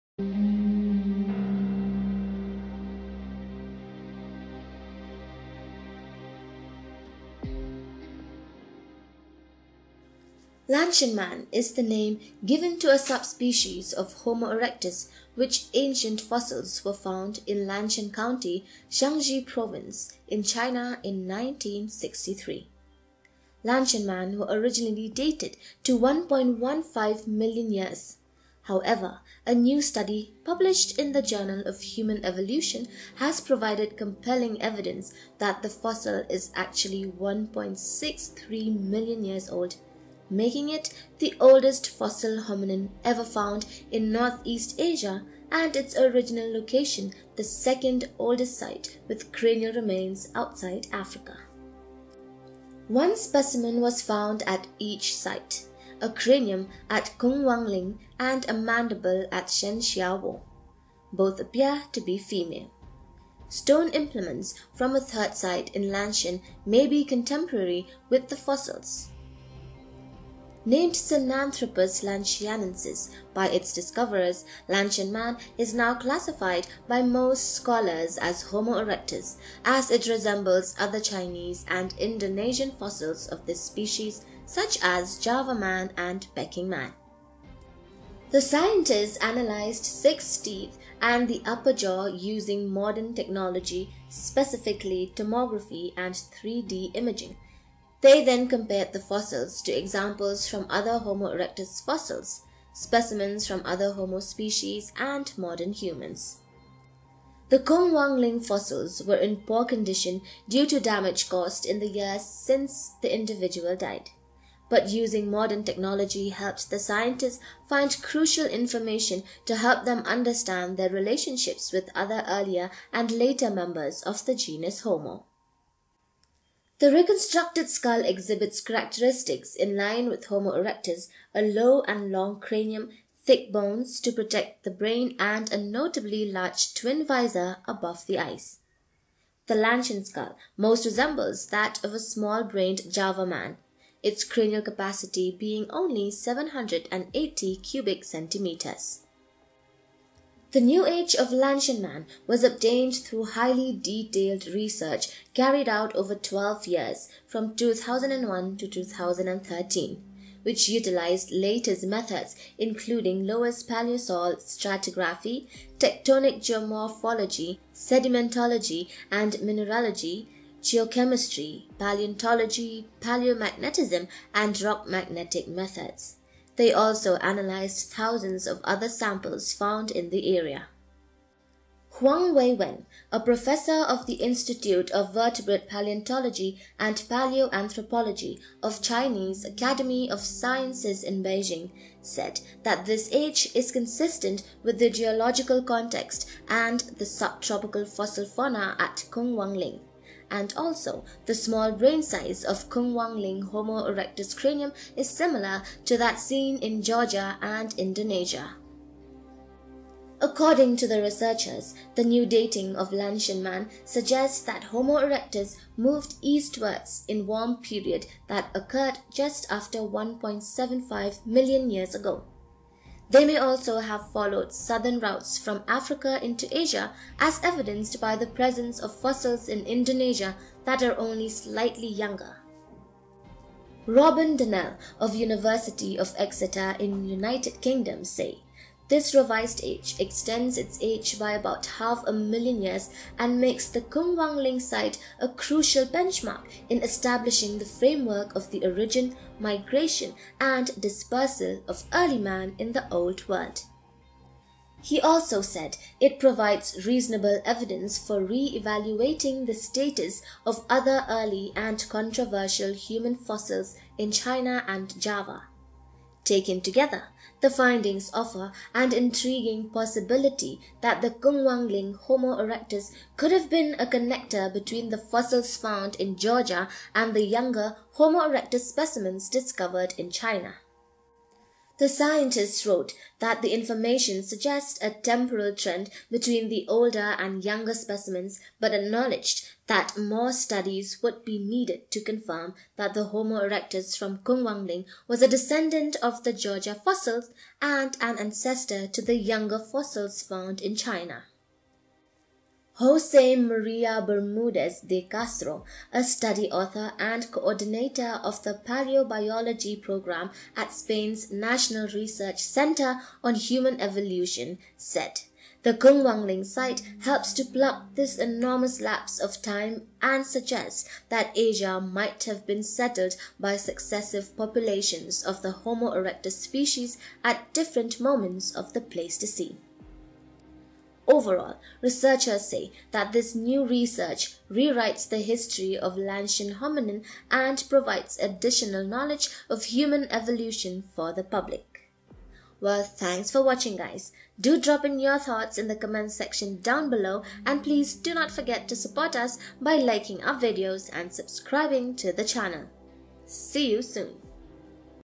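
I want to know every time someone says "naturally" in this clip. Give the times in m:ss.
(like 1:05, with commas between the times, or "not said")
not said.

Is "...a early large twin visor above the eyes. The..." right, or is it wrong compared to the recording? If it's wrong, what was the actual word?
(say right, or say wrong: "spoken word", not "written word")
wrong: "notably", not "early".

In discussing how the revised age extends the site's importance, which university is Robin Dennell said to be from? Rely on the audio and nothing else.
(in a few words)
University of Exeter.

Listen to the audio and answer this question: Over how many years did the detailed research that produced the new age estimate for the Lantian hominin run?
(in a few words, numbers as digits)
12.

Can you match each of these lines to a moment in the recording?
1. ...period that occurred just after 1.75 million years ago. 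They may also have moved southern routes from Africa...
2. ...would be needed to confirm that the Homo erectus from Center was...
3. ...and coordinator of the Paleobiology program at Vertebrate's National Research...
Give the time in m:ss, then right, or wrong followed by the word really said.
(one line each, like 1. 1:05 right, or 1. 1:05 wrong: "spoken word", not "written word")
1. 3:37 wrong: "followed", not "moved"
2. 4:51 wrong: "Kungwangling", not "Center"
3. 5:06 wrong: "Spain", not "Vertebrate".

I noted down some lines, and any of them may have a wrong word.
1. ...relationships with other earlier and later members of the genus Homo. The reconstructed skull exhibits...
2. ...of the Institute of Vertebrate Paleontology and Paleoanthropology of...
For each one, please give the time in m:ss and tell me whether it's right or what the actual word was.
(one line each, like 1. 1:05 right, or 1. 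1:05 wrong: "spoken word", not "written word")
1. 2:00 right
2. 3:03 right.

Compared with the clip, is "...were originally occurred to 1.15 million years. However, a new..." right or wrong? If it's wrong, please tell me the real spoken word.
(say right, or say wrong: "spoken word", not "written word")
wrong: "dated", not "occurred".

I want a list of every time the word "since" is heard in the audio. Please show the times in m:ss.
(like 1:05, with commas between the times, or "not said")
1:52.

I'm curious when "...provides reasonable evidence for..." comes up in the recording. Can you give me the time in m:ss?
4:16.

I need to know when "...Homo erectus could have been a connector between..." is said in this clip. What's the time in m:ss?
4:31.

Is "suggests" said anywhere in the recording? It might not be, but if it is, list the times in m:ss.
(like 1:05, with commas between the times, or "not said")
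3:33, 4:44, 5:20.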